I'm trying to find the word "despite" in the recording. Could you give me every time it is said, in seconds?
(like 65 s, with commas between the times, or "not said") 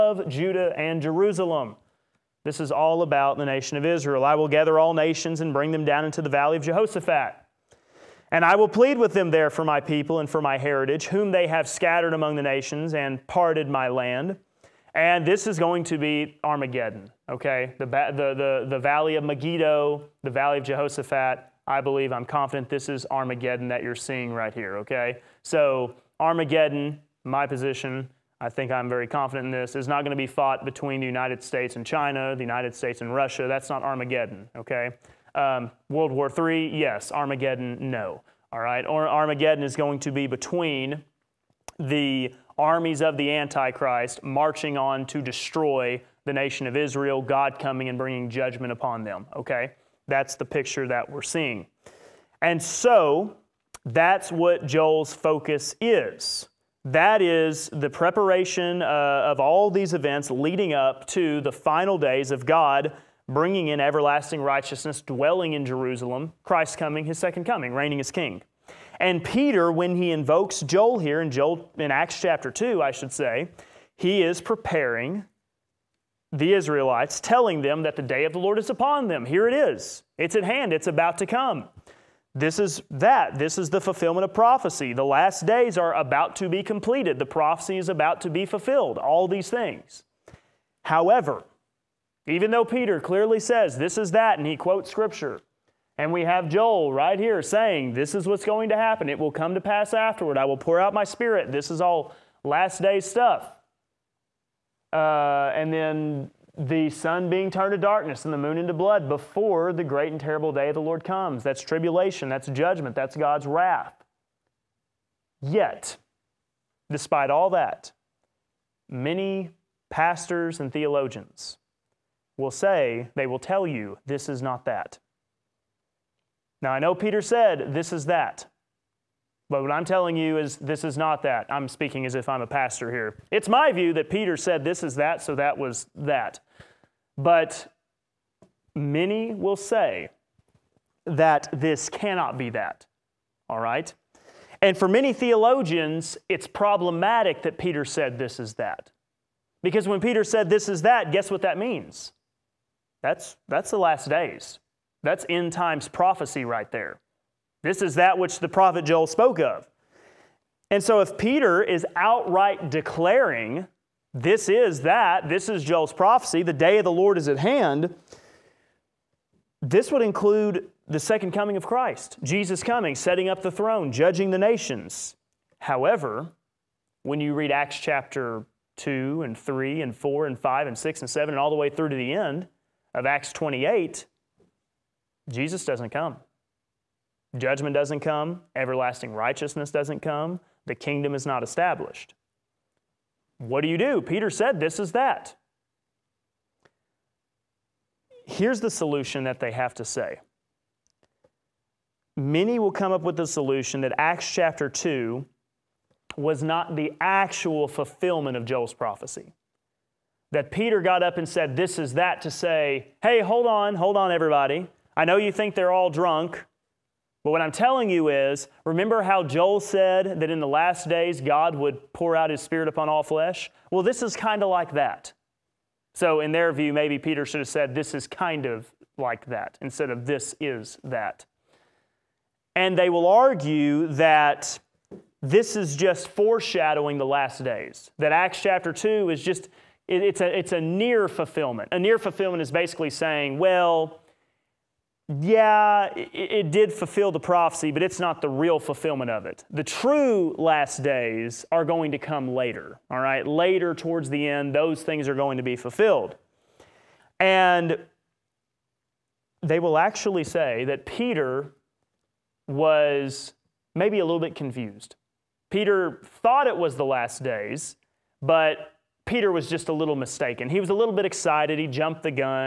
116 s.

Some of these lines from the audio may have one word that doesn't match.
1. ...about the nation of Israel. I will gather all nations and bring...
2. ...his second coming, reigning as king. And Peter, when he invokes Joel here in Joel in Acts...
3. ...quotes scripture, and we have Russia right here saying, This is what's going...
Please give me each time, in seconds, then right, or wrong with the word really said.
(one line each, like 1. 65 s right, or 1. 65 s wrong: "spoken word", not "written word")
1. 3 s right
2. 67 s right
3. 94 s wrong: "Joel", not "Russia".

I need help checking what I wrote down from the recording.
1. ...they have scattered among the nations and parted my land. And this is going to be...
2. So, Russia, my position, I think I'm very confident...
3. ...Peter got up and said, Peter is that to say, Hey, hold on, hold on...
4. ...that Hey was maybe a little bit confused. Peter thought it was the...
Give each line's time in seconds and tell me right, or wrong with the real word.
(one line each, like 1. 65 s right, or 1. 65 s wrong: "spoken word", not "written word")
1. 11 s right
2. 25 s wrong: "Armageddon", not "Russia"
3. 210 s wrong: "This", not "Peter"
4. 260 s wrong: "Peter", not "Hey".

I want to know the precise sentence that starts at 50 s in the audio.
That's the picture that we're seeing.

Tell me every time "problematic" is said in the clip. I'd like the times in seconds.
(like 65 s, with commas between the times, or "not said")
146 s.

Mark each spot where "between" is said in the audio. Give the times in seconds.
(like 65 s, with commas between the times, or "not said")
30 s, 40 s.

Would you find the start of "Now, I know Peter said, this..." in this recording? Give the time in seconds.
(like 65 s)
126 s.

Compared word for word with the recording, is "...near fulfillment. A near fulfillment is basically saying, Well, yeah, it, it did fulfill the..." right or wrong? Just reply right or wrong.
right.